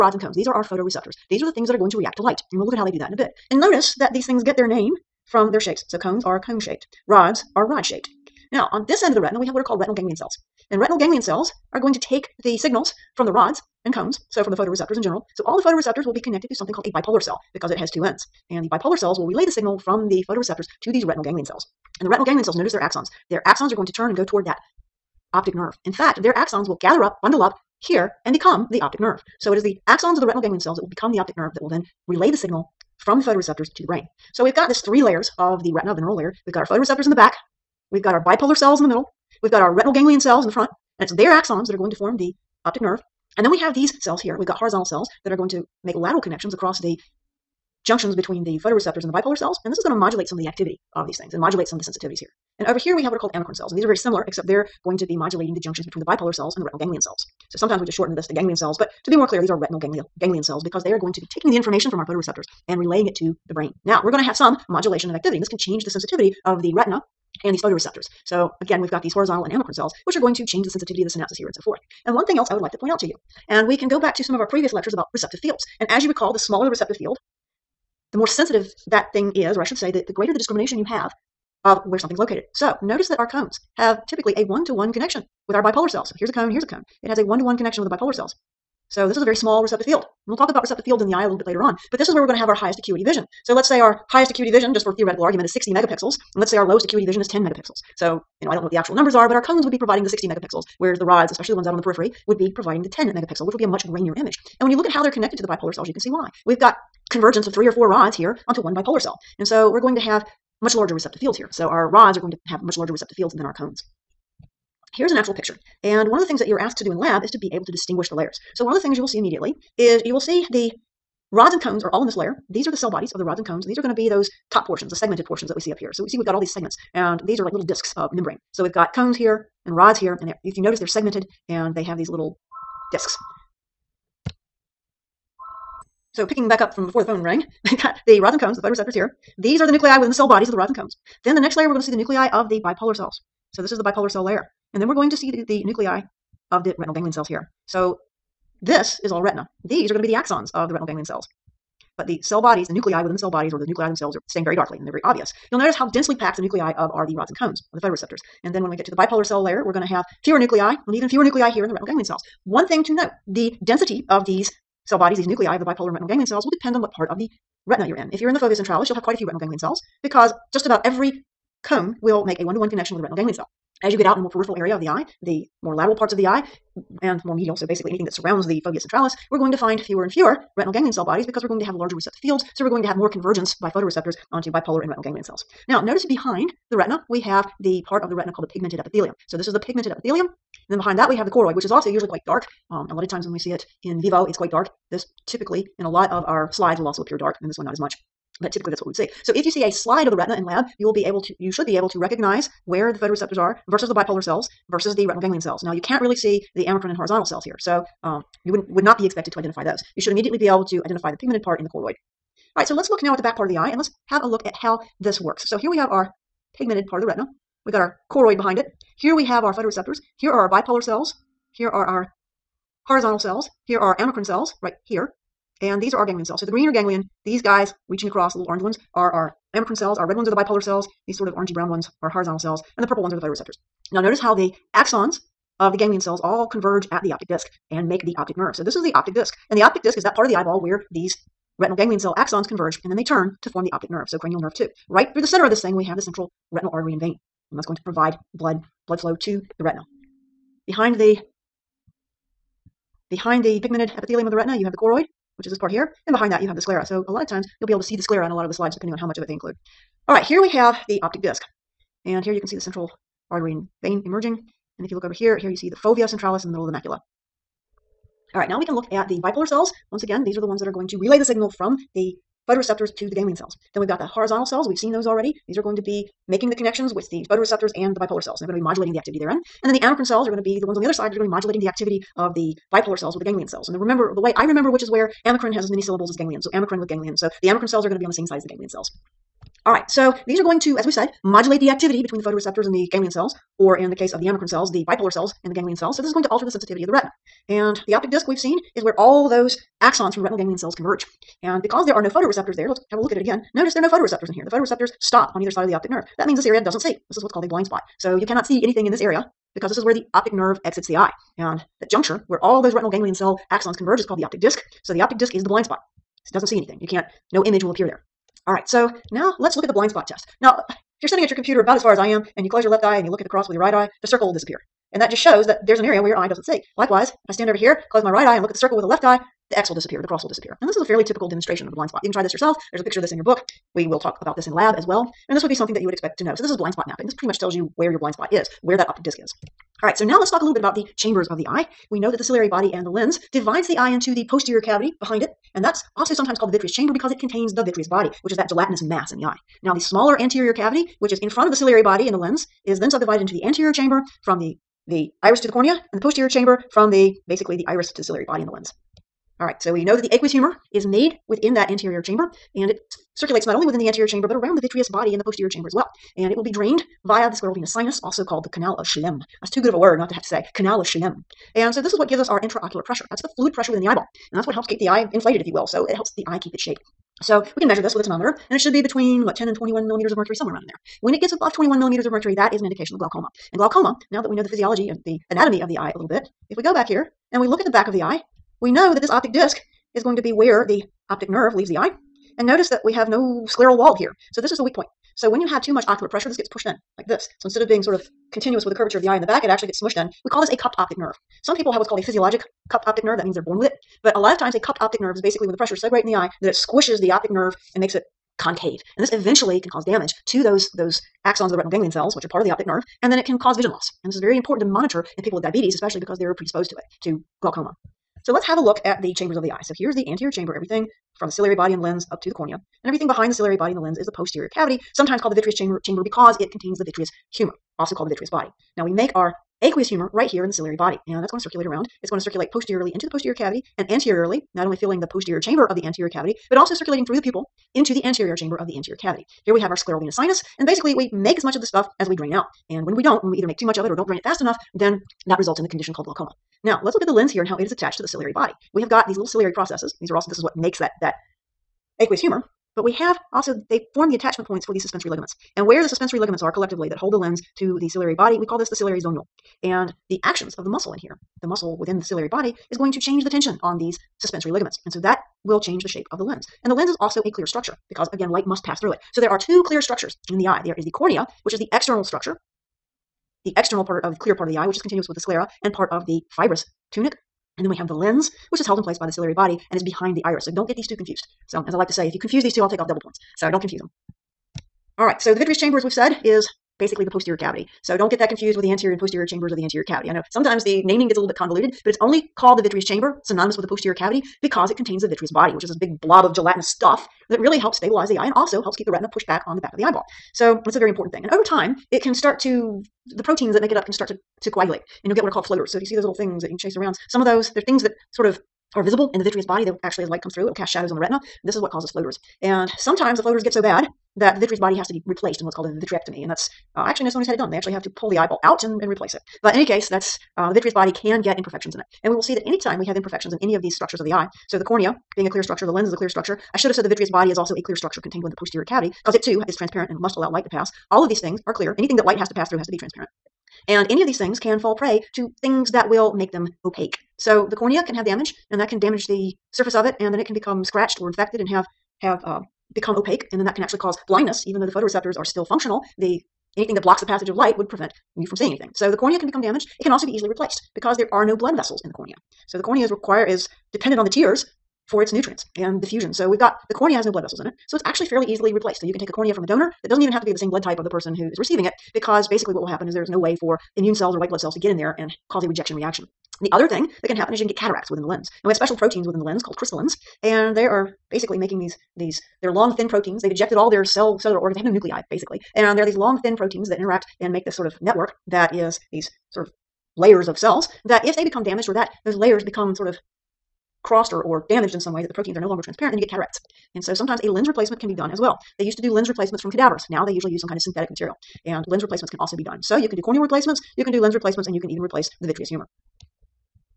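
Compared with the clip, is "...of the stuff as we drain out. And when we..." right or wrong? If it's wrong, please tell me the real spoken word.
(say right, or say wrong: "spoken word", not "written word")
right.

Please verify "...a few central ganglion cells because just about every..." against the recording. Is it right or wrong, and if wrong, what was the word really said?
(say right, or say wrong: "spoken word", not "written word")
wrong: "retinal", not "central".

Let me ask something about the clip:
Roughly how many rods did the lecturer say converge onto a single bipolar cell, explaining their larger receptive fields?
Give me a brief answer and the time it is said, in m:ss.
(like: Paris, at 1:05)
three or four, at 1:47.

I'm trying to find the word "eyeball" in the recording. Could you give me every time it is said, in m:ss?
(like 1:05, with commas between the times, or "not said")
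4:00, 6:13, 8:19, 8:38.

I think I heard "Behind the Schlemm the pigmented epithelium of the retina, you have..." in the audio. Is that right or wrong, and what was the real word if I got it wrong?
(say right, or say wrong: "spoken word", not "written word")
wrong: "Behind", not "Schlemm".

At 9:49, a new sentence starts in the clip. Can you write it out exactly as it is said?
Now they usually use some kind of synthetic material.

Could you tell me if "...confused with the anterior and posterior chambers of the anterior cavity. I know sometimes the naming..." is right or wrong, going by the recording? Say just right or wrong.
right.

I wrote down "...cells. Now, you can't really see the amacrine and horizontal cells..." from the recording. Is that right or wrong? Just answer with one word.
right.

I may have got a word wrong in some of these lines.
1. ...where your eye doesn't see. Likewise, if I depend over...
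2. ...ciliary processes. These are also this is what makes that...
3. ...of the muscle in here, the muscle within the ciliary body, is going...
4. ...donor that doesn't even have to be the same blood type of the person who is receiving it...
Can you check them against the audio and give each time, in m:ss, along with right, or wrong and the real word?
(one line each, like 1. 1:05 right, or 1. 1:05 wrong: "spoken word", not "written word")
1. 5:26 wrong: "stand", not "depend"
2. 7:29 right
3. 7:40 right
4. 9:19 right.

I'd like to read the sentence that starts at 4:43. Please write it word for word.
And the remember the way I remember which is where amacrine has as many syllables as ganglion.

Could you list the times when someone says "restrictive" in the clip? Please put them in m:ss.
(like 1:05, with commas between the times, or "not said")
not said.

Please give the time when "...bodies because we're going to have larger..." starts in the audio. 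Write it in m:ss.
3:01.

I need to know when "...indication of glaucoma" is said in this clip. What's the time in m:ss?
6:22.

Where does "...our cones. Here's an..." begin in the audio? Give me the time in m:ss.
1:53.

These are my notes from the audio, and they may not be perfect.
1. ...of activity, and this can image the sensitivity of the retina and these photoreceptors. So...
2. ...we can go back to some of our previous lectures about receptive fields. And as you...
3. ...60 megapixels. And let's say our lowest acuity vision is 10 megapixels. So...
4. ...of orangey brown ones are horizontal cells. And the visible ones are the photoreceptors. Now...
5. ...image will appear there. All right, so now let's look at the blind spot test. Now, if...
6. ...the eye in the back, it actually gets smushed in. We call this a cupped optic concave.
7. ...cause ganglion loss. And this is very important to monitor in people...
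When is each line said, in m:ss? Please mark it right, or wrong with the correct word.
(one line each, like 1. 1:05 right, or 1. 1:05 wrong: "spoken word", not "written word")
1. 1:05 wrong: "change", not "image"
2. 1:13 right
3. 1:35 right
4. 3:51 wrong: "purple", not "visible"
5. 5:17 right
6. 6:39 wrong: "nerve", not "concave"
7. 6:53 wrong: "vision", not "ganglion".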